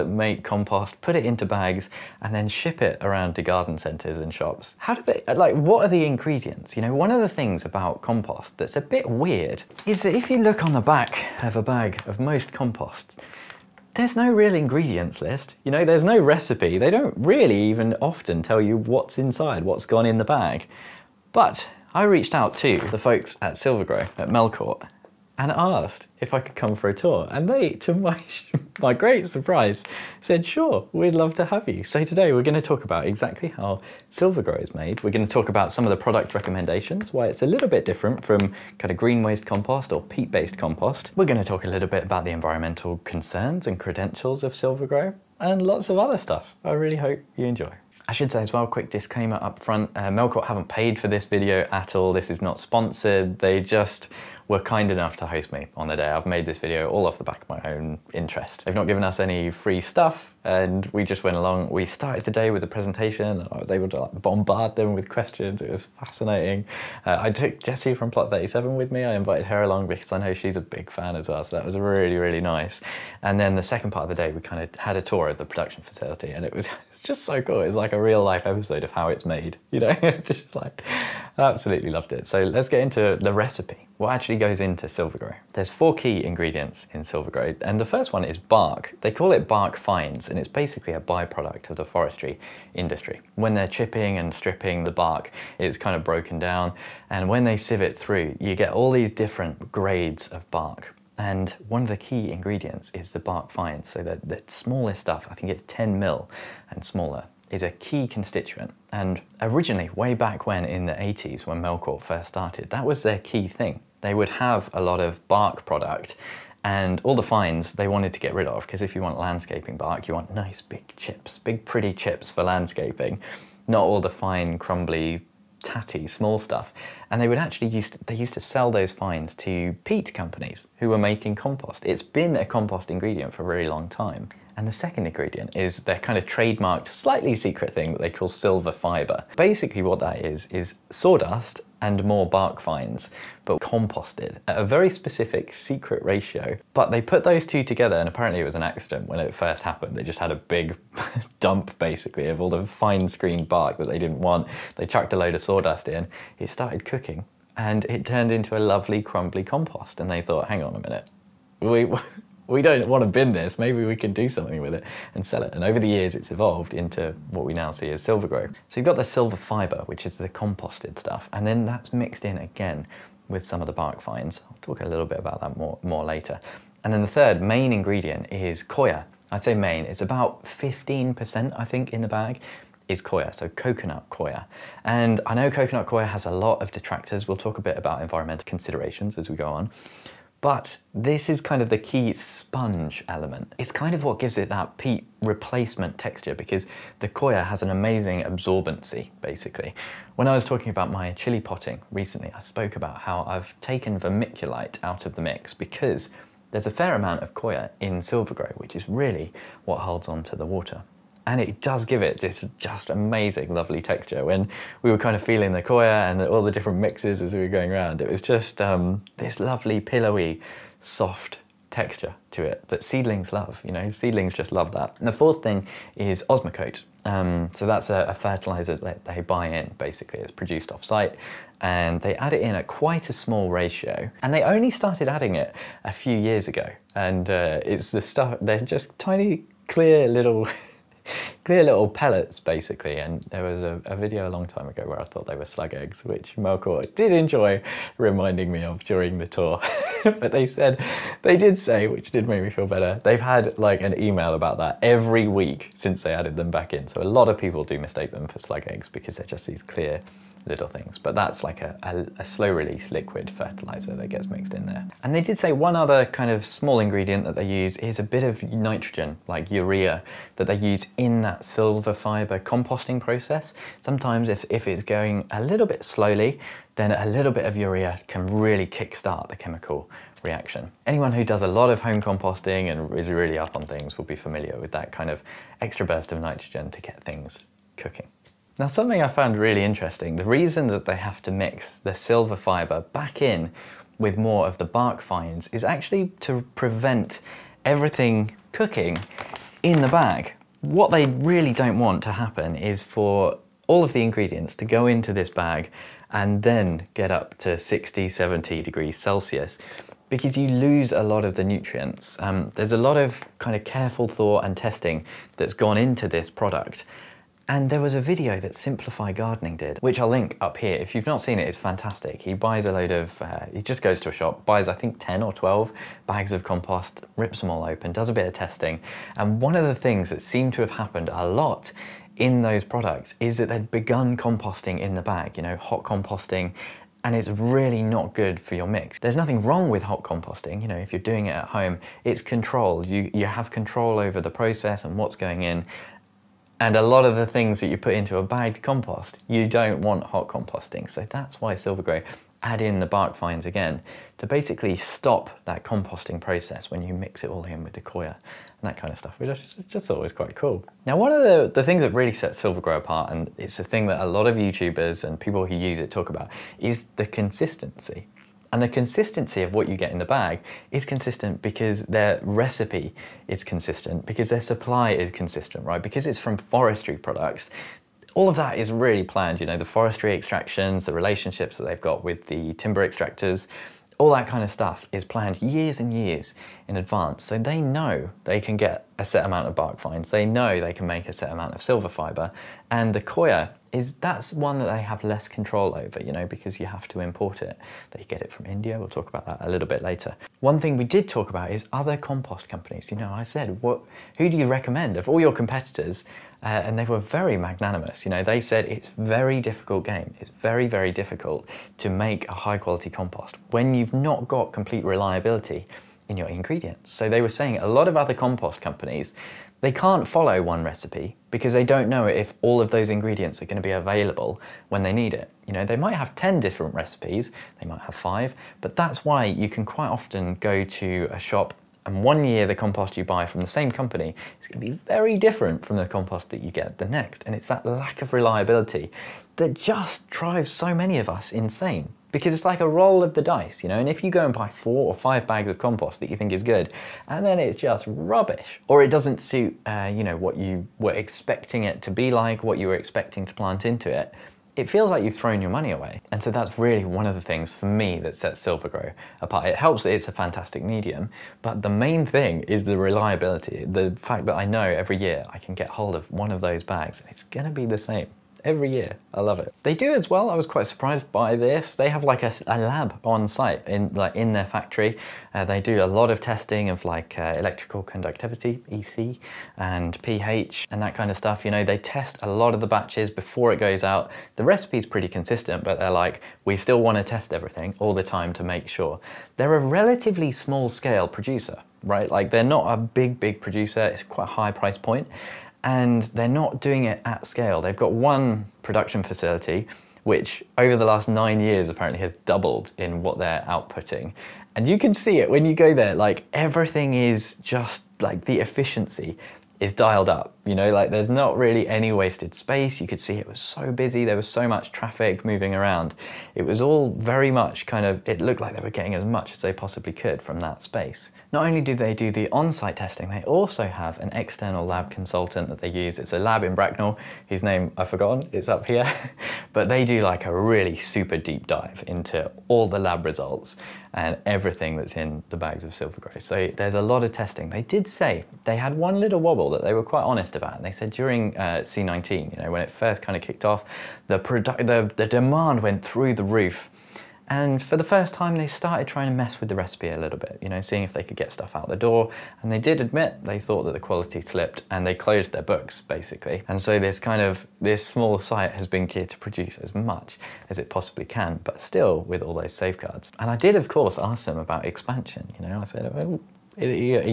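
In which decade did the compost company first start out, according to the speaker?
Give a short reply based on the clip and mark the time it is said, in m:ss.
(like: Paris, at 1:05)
the 80s, at 1:50.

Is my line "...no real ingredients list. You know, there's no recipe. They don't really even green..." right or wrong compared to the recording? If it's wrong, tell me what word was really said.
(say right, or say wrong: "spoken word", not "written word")
wrong: "often", not "green".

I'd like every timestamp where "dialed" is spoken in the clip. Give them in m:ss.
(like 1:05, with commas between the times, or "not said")
8:29.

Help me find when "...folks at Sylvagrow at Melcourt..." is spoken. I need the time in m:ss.
0:22.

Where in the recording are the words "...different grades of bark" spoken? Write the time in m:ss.
1:39.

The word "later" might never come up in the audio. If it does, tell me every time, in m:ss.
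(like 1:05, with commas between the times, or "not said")
2:56, 6:39.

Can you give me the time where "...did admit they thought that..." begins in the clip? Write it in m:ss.
9:12.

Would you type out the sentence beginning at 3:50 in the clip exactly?
It's produced off-site and they add it in at quite a small ratio.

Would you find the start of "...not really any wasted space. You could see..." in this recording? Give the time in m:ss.
8:31.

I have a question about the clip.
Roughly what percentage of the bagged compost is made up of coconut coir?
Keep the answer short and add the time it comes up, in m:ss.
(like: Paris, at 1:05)
15%, at 3:00.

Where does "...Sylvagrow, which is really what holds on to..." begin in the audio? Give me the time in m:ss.
3:27.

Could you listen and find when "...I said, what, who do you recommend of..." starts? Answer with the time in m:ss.
6:43.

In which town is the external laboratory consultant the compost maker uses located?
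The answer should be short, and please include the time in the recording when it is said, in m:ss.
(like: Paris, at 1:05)
Bracknell, at 8:46.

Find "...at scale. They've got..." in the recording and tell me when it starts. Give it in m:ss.
8:17.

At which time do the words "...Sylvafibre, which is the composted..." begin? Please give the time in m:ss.
2:49.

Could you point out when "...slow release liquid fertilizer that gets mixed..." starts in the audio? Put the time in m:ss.
4:22.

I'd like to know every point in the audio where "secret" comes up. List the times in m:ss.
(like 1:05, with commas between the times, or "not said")
2:17, 2:25.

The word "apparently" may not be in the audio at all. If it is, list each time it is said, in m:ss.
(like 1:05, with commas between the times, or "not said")
2:28, 8:21.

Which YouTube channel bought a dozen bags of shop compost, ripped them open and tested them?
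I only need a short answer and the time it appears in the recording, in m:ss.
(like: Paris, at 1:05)
Simplify Gardening, at 5:18.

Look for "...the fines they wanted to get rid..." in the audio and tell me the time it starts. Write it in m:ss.
1:57.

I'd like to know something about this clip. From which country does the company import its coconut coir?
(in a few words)
India.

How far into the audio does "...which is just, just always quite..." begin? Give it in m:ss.
5:59.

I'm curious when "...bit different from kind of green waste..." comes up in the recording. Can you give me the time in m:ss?
0:37.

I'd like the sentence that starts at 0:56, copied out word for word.
I've made this video all off the back of my own interest.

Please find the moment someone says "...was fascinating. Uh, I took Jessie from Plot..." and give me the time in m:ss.
1:05.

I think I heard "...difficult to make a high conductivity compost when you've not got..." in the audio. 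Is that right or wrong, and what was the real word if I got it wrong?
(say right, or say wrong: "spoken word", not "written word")
wrong: "quality", not "conductivity".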